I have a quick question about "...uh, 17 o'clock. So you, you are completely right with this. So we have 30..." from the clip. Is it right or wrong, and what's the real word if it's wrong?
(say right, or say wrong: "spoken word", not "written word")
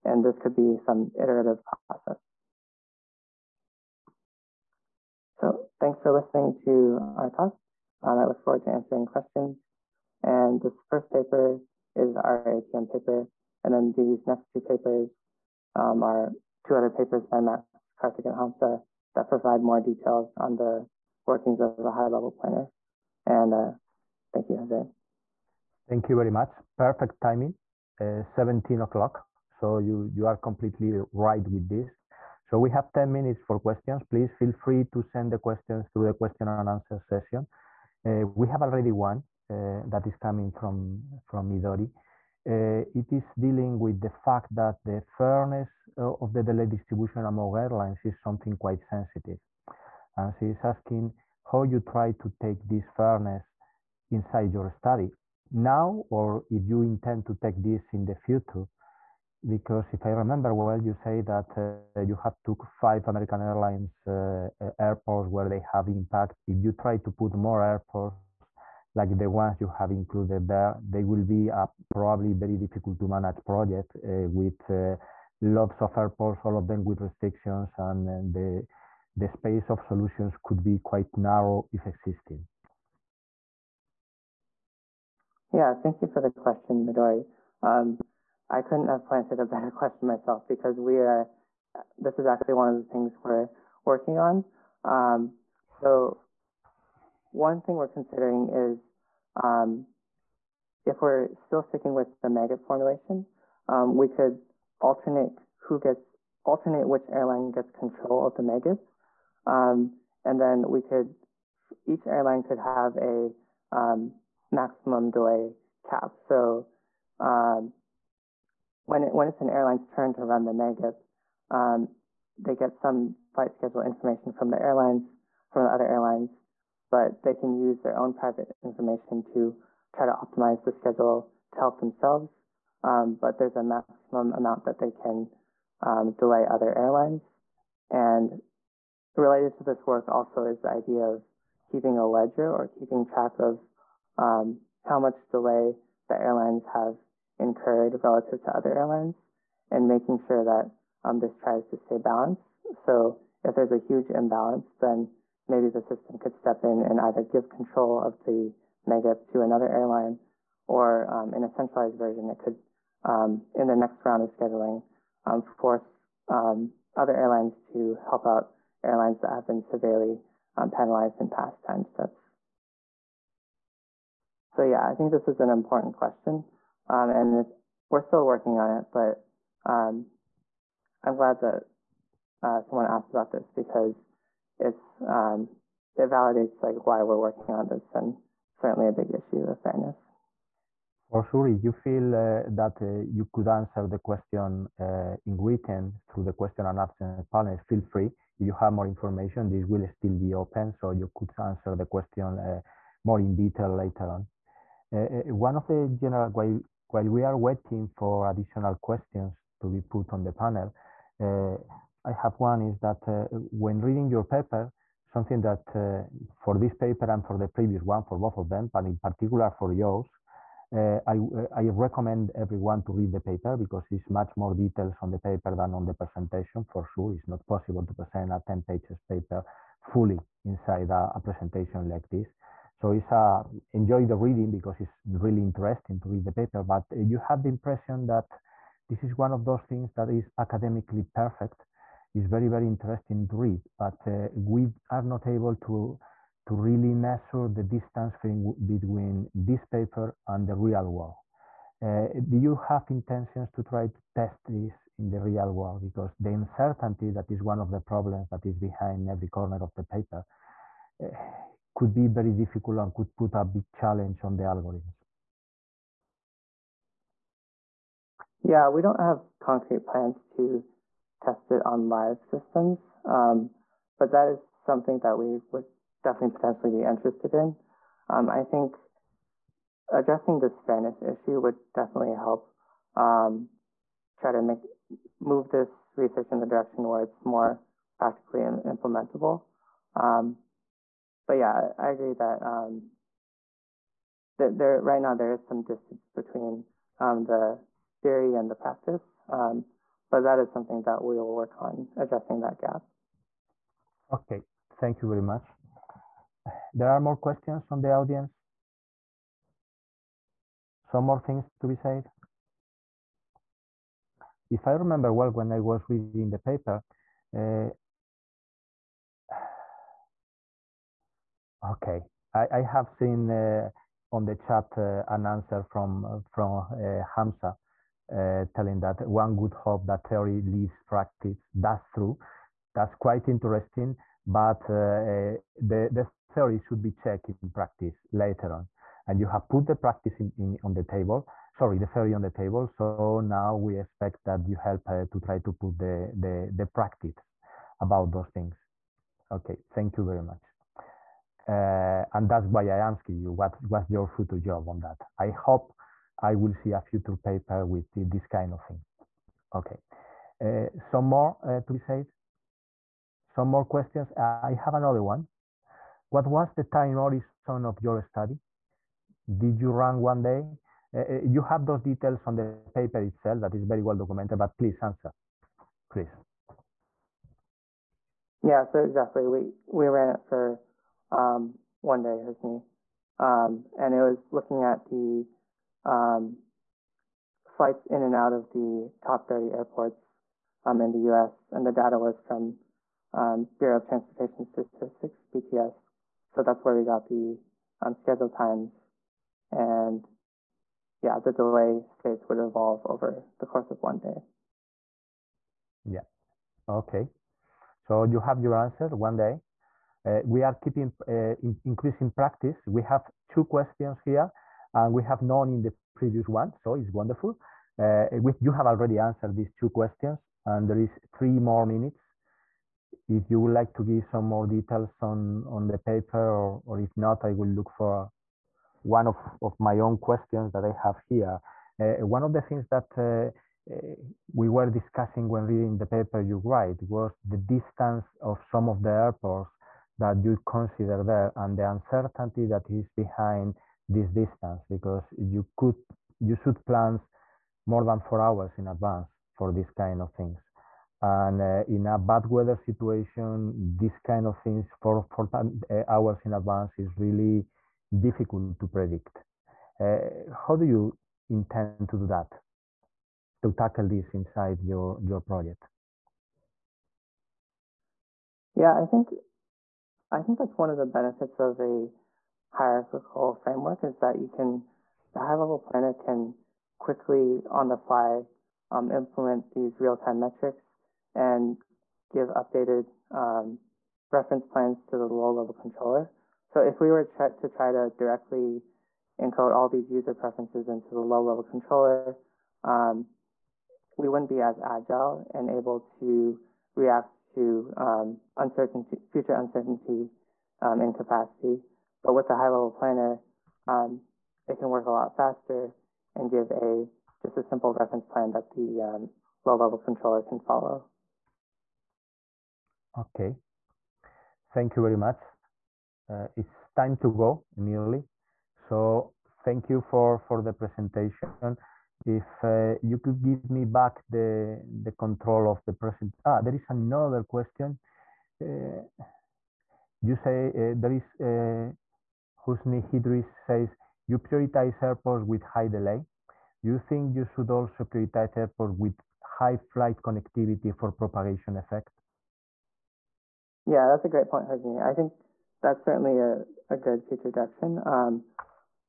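wrong: "10", not "30".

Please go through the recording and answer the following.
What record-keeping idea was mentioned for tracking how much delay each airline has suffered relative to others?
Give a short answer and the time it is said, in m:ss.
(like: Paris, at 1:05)
A ledger, at 2:22.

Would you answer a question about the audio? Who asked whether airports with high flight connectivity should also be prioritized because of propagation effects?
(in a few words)
Husni Idris.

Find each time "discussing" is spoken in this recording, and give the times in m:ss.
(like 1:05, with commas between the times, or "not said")
7:14.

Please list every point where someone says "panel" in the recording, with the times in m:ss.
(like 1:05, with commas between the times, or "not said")
3:17, 3:30.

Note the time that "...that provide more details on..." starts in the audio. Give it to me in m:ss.
0:19.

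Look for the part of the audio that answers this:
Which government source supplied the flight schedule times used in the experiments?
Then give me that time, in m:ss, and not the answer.
6:33.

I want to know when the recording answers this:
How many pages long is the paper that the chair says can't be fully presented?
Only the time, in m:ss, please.
3:48.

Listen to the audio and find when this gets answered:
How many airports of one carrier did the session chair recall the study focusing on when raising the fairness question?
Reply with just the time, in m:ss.
1:02.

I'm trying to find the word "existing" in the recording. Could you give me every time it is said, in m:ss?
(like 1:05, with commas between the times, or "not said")
1:21.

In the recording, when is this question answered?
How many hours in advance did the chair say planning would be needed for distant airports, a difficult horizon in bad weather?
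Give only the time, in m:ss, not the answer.
7:27.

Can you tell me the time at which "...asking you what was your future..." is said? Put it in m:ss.
5:52.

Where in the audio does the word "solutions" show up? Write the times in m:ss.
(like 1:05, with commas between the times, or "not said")
1:19.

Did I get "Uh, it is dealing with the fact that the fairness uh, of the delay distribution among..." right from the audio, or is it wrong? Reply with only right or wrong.
right.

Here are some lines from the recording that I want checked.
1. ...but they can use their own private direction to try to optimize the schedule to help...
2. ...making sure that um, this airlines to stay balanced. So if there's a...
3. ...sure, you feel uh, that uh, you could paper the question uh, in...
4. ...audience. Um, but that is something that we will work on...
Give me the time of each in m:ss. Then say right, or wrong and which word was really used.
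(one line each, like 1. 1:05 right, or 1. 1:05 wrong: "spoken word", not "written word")
1. 2:06 wrong: "information", not "direction"
2. 2:29 wrong: "tries", not "airlines"
3. 3:11 wrong: "answer", not "paper"
4. 4:58 wrong: "practice", not "audience".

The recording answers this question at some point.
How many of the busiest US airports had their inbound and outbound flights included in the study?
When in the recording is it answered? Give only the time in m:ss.
6:29.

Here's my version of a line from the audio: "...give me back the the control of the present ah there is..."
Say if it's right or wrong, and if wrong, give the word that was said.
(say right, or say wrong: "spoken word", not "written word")
right.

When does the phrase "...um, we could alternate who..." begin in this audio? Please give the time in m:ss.
1:43.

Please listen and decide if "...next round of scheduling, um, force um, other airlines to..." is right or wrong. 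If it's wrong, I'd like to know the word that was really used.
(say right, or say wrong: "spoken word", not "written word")
right.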